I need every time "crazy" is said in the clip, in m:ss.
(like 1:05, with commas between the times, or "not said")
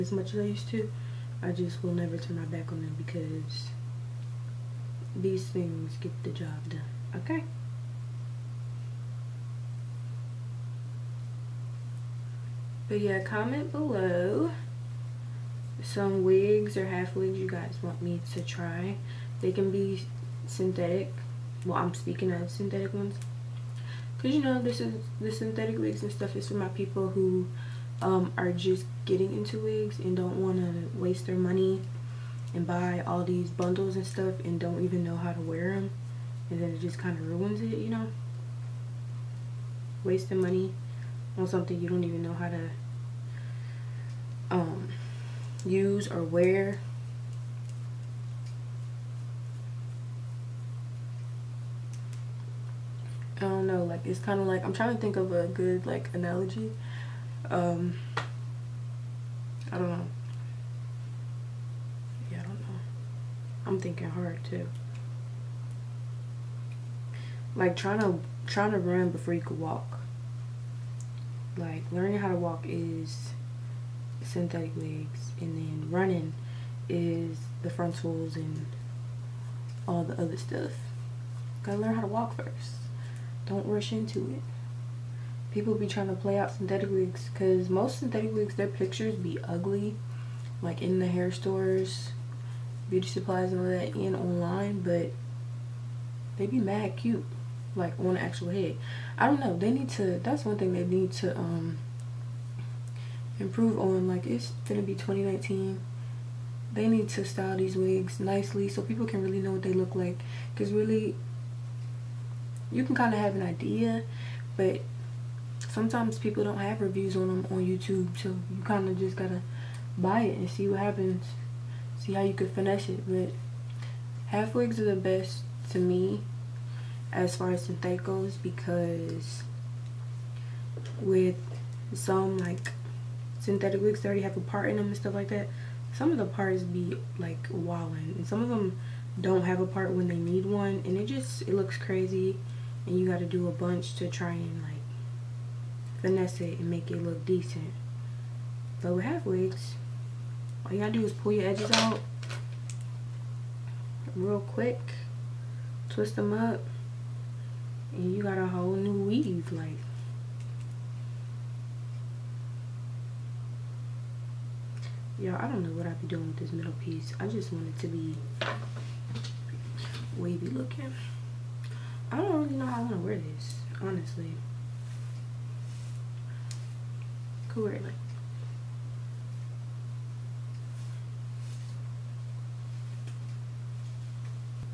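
2:21.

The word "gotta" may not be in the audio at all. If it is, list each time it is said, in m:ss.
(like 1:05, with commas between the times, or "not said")
1:21, 1:59, 2:30.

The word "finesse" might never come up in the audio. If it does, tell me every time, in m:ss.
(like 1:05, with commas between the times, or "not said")
2:02, 2:26.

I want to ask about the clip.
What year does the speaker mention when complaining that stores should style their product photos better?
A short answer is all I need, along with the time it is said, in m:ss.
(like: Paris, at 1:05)
2019, at 1:44.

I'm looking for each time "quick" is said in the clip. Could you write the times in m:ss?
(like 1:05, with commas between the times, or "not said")
2:34.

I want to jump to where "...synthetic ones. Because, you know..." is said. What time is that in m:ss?
0:22.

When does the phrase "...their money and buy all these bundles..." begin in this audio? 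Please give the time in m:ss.
0:31.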